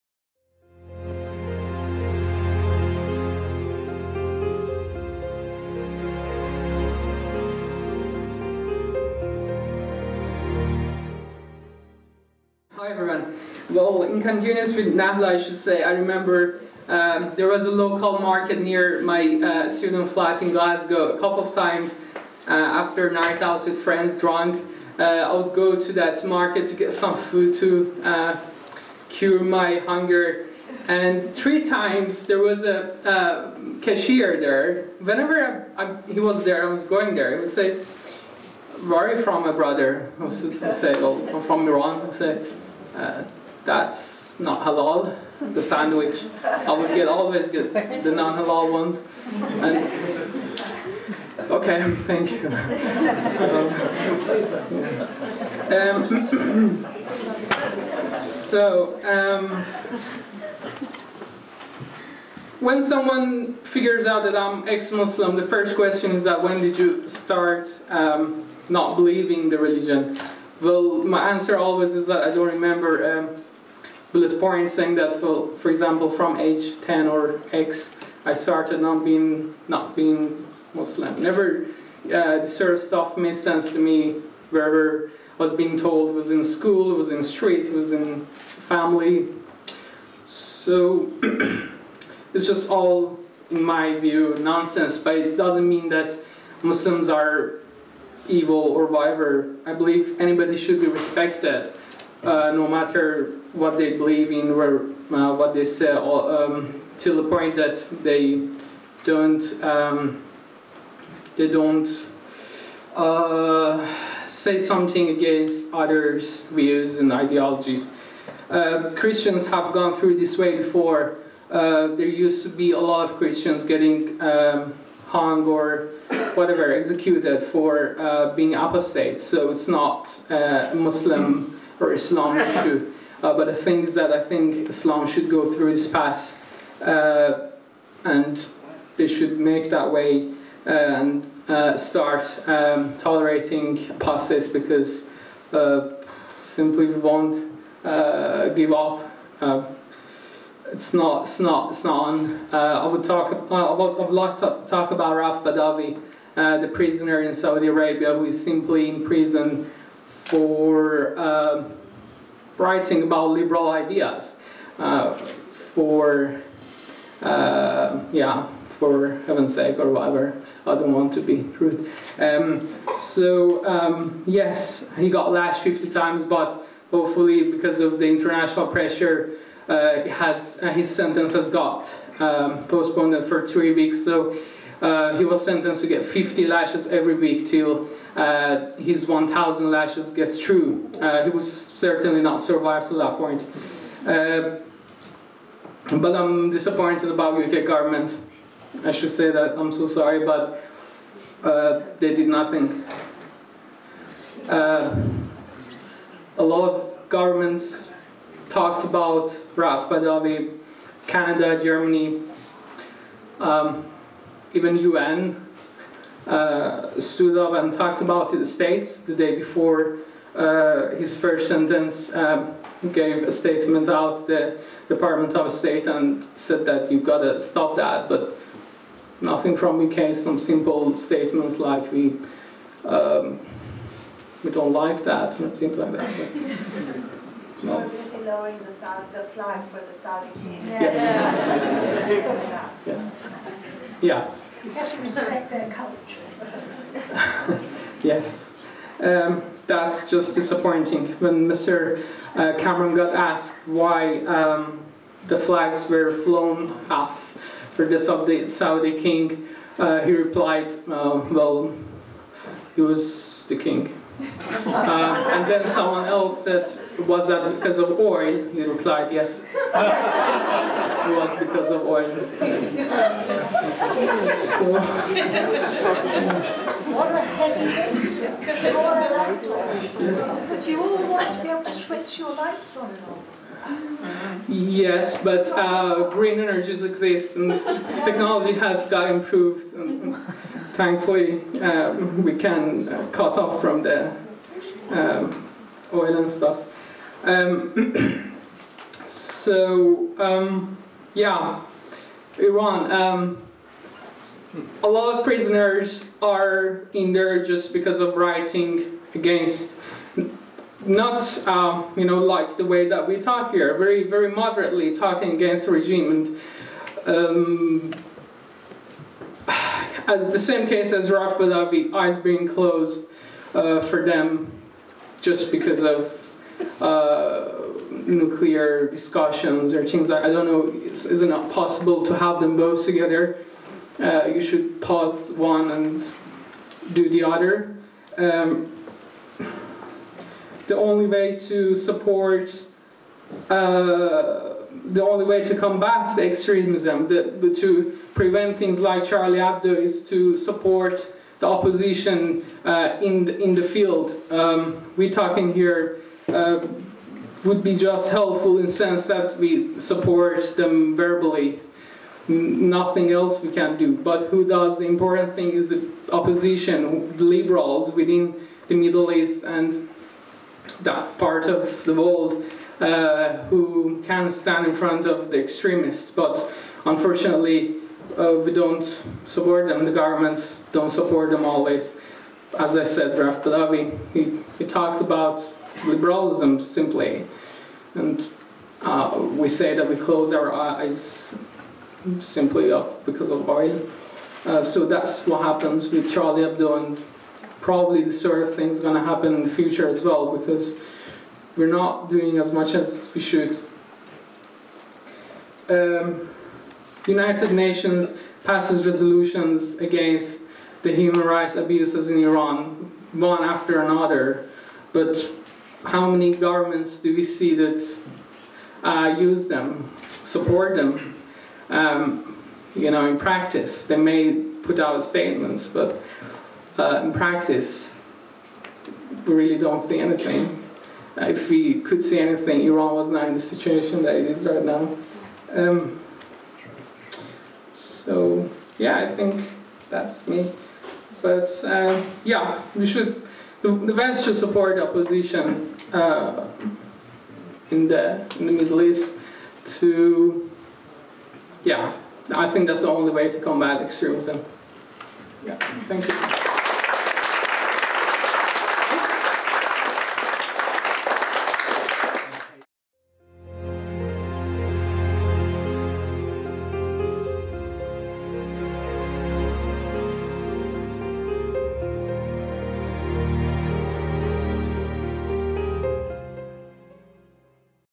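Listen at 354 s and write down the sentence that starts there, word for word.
Um, we're talking here um, would be just helpful in sense that we support them verbally.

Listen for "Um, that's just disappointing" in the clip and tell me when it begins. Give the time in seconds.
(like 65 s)
248 s.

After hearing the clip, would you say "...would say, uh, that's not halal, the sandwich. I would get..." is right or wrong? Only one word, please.
right.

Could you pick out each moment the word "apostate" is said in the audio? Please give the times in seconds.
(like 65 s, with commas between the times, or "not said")
128 s, 143 s.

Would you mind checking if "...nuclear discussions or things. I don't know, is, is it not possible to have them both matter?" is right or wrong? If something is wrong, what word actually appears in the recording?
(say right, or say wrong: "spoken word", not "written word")
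wrong: "together", not "matter".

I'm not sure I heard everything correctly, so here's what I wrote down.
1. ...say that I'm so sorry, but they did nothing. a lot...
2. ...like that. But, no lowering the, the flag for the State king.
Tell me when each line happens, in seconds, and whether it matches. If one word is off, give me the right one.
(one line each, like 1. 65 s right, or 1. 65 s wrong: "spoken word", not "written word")
1. 199 s right
2. 235 s wrong: "Saudi", not "State".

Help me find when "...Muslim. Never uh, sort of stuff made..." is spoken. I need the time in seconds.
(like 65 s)
80 s.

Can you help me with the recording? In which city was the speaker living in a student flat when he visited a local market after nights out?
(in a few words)
Glasgow.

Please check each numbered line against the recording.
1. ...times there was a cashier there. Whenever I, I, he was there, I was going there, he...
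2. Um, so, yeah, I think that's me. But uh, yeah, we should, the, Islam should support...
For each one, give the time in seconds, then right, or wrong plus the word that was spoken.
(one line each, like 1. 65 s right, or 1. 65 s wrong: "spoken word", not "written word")
1. 31 s right
2. 435 s wrong: "West", not "Islam".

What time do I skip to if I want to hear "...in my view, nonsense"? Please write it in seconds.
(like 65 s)
93 s.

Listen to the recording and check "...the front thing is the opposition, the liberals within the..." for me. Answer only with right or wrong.
wrong.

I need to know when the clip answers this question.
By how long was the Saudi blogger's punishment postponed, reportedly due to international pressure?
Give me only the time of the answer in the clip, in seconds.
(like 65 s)
183 s.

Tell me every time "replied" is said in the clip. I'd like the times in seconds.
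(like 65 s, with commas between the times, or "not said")
260 s, 268 s.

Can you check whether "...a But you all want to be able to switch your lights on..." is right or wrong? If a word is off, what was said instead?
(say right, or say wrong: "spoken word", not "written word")
right.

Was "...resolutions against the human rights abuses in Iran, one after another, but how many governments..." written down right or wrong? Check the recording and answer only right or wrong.
right.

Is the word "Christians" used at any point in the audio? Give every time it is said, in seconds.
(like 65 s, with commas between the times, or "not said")
118 s, 123 s.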